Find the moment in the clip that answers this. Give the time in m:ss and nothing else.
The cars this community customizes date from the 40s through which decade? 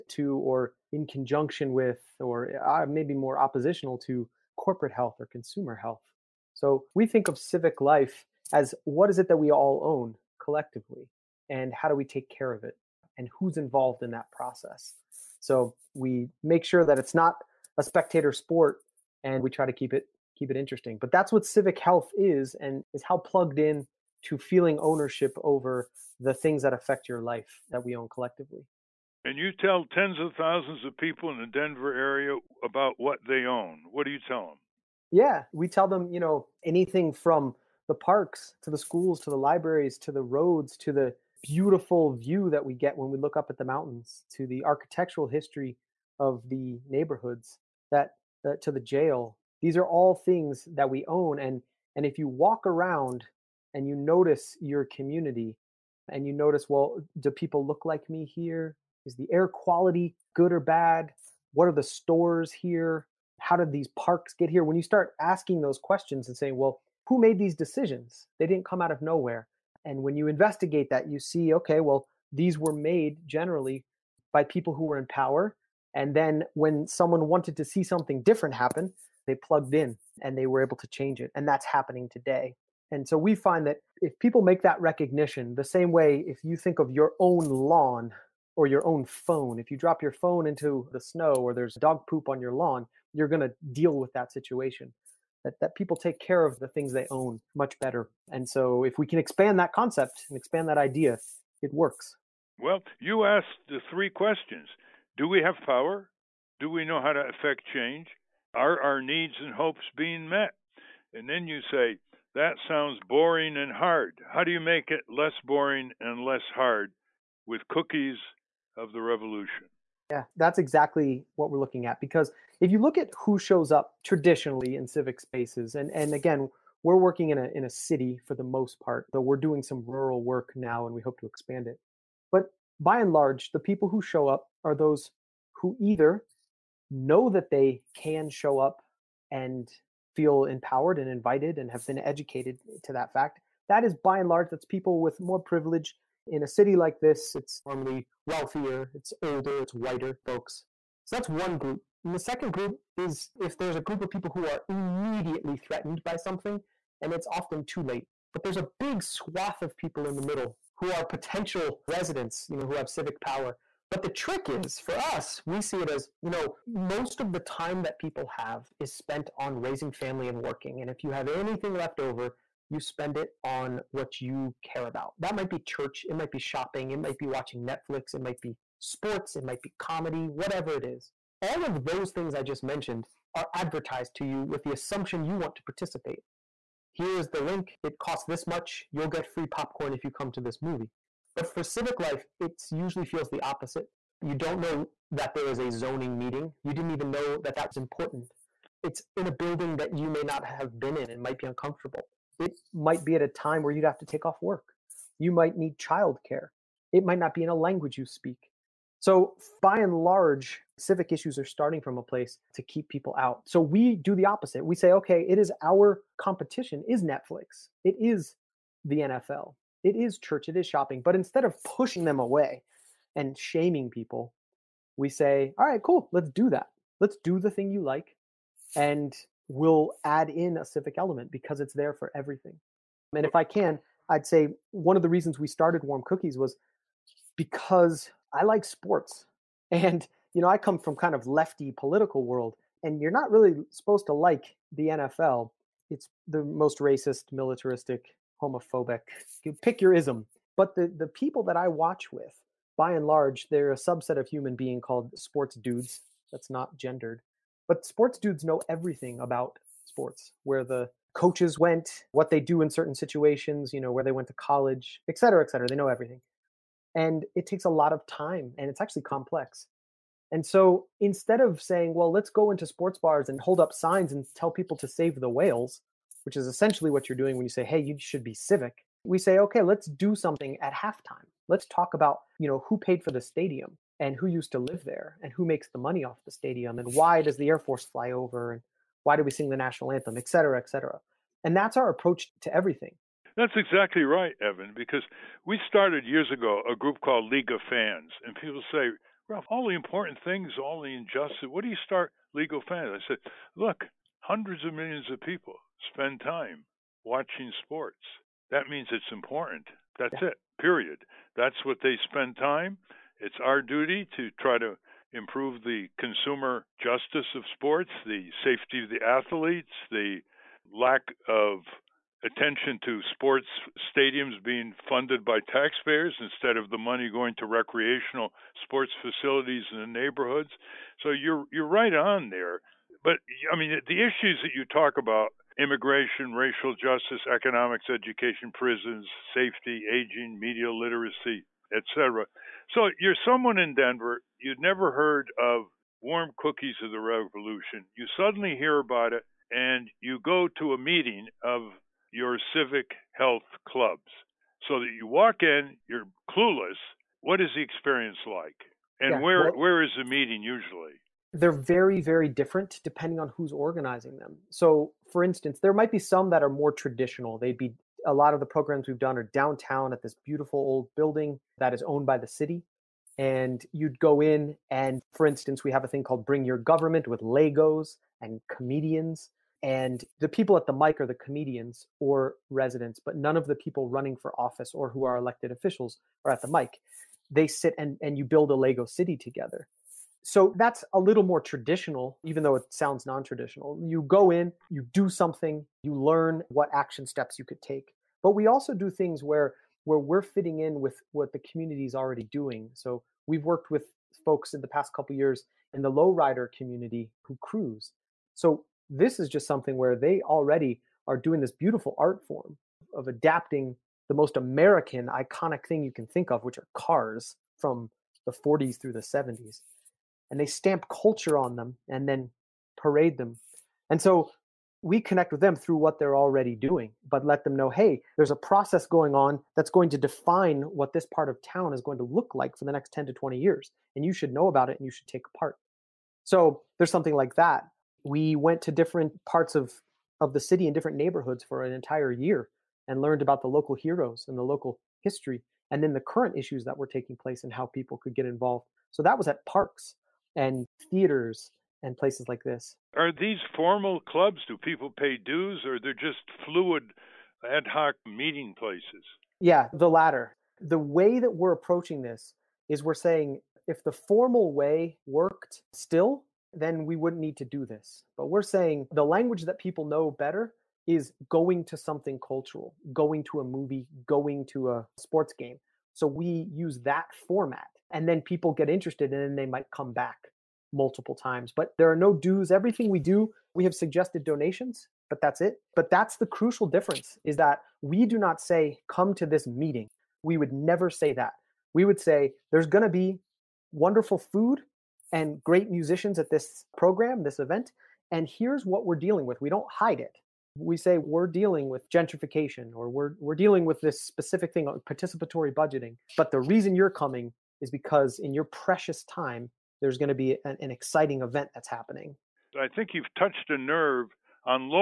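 6:58.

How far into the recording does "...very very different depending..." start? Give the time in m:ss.
6:01.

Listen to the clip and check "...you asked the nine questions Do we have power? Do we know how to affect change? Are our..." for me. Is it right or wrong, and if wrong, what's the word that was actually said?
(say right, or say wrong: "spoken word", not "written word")
wrong: "three", not "nine".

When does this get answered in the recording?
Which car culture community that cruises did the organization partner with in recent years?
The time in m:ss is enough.
6:45.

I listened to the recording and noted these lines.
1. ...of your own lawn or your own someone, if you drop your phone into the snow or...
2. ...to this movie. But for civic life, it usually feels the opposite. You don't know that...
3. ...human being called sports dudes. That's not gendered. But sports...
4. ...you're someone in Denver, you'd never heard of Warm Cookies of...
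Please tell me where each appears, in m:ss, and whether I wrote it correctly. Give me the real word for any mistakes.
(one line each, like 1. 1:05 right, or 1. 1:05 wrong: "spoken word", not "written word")
1. 1:26 wrong: "phone", not "someone"
2. 3:10 right
3. 4:14 right
4. 5:43 right.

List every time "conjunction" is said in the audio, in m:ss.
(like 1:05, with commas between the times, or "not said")
0:01.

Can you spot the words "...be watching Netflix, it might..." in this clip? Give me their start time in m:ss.
2:57.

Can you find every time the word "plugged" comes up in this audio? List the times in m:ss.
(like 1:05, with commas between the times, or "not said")
0:23, 1:19.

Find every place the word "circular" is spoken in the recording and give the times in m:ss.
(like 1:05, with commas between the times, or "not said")
not said.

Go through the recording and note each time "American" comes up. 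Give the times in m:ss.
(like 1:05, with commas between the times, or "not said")
6:54.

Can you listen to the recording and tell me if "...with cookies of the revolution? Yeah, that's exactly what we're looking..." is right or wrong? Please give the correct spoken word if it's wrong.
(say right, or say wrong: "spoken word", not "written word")
right.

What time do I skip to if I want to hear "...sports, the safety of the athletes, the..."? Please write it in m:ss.
5:17.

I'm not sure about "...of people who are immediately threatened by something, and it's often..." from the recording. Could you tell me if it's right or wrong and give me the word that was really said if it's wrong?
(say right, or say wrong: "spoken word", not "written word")
right.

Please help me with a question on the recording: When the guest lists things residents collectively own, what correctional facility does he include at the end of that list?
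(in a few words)
The jail.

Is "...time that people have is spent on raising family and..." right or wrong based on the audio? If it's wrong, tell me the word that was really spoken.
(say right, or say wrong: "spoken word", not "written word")
right.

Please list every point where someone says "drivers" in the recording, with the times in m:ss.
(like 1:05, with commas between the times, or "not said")
not said.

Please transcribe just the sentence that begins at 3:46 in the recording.
Let's do the thing you like and will add in a civic element because it's there for everything.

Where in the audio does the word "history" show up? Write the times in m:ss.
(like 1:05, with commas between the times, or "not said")
0:45, 7:25.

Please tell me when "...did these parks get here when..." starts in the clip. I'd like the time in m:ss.
1:03.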